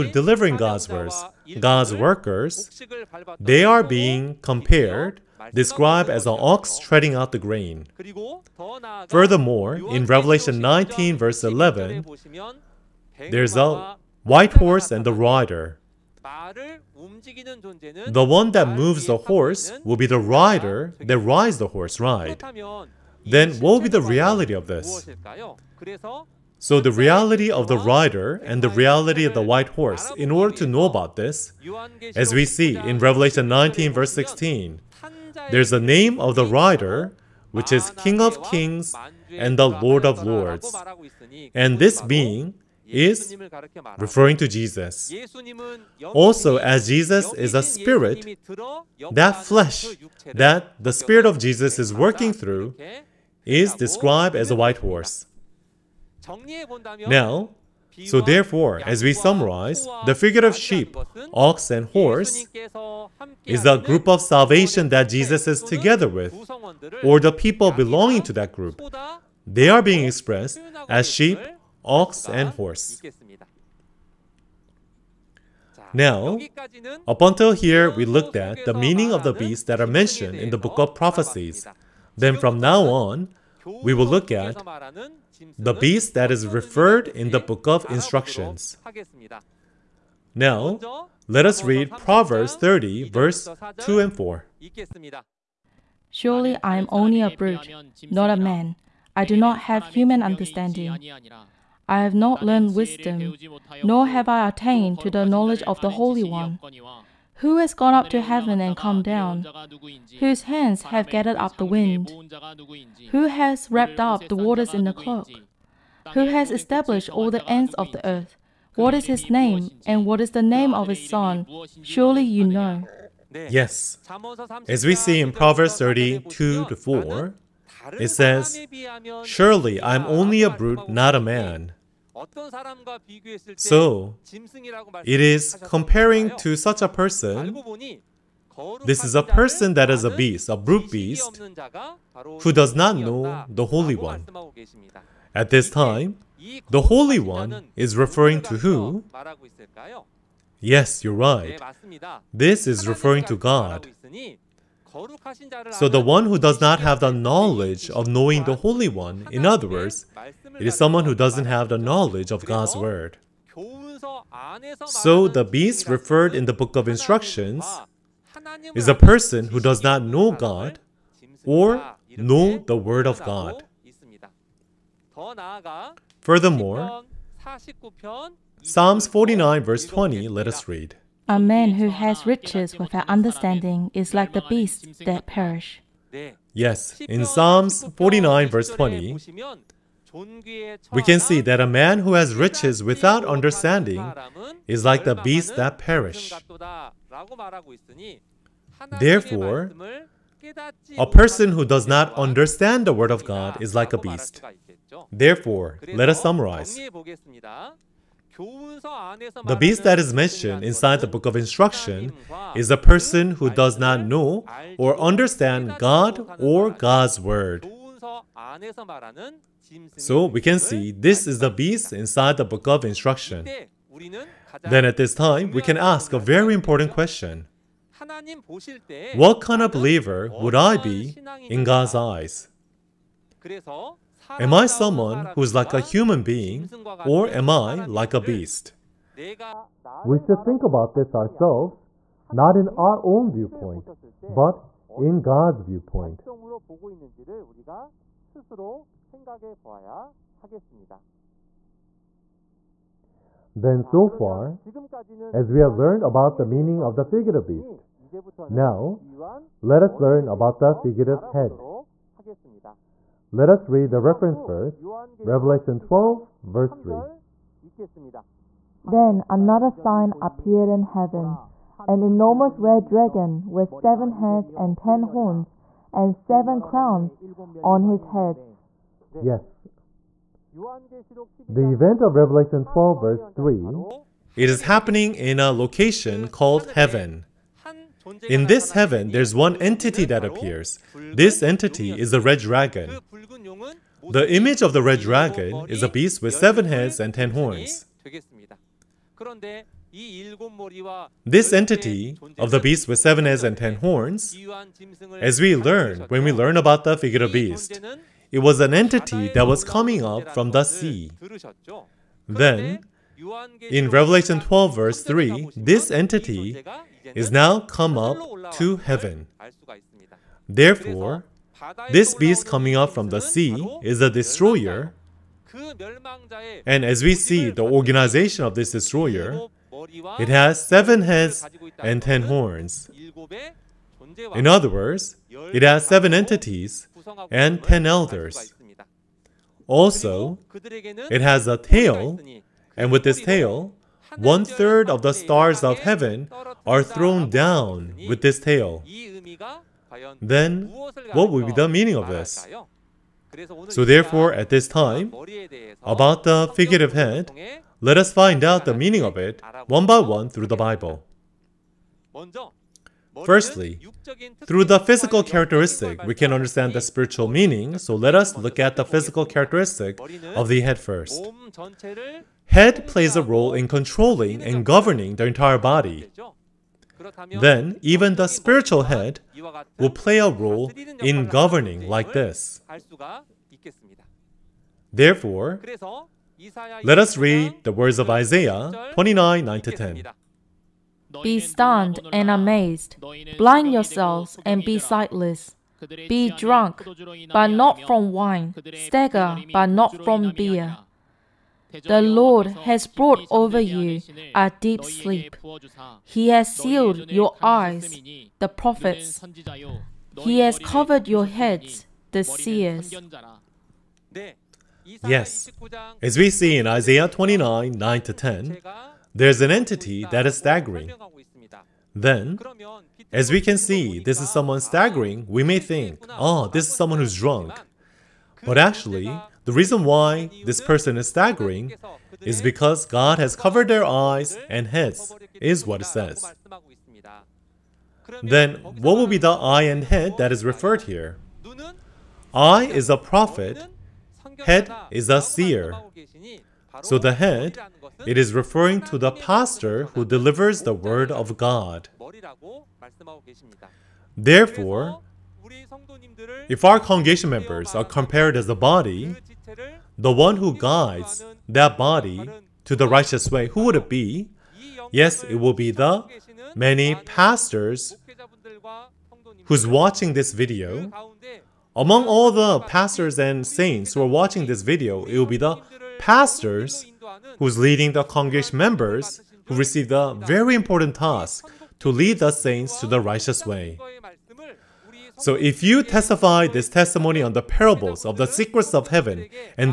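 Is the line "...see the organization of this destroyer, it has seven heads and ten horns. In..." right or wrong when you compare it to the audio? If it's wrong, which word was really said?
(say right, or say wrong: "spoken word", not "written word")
right.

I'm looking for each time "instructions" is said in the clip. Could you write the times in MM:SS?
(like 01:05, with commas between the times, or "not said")
01:27, 02:46, 03:31, 03:42.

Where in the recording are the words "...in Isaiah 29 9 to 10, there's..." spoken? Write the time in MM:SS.
06:56.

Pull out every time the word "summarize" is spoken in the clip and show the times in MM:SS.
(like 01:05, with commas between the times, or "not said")
00:59, 03:26.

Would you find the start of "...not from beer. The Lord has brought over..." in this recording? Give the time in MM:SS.
06:39.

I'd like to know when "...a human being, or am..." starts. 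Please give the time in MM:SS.
03:55.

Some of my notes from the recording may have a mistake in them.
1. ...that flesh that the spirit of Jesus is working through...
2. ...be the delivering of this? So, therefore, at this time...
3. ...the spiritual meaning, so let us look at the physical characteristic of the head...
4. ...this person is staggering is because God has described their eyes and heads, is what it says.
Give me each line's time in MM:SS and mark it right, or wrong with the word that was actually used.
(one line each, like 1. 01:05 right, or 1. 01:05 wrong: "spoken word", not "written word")
1. 00:49 right
2. 05:51 wrong: "meaning", not "delivering"
3. 06:06 right
4. 07:10 wrong: "covered", not "described".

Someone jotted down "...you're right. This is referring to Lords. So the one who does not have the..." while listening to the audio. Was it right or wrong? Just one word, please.
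wrong.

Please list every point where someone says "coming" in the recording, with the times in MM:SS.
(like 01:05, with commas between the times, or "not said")
05:09, 05:22.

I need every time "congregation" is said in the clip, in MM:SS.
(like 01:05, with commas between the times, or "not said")
07:36, 07:58.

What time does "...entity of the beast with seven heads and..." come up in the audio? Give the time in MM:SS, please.
05:01.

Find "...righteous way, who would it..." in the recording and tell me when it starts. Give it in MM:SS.
07:42.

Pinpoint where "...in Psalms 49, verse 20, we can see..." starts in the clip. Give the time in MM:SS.
03:07.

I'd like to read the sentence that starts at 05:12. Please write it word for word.
Then, in Revelation 12 verse 3, this entity is now come up to heaven.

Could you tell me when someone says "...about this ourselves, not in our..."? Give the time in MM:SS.
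04:00.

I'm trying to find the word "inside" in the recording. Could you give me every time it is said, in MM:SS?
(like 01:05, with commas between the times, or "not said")
03:30, 03:41.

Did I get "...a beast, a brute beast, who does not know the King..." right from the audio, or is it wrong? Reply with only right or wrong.
wrong.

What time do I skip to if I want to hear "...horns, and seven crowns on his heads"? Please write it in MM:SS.
04:35.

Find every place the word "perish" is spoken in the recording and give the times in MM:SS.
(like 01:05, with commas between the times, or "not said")
03:05, 03:15.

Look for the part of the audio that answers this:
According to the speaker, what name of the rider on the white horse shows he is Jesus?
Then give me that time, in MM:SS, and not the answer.
00:37.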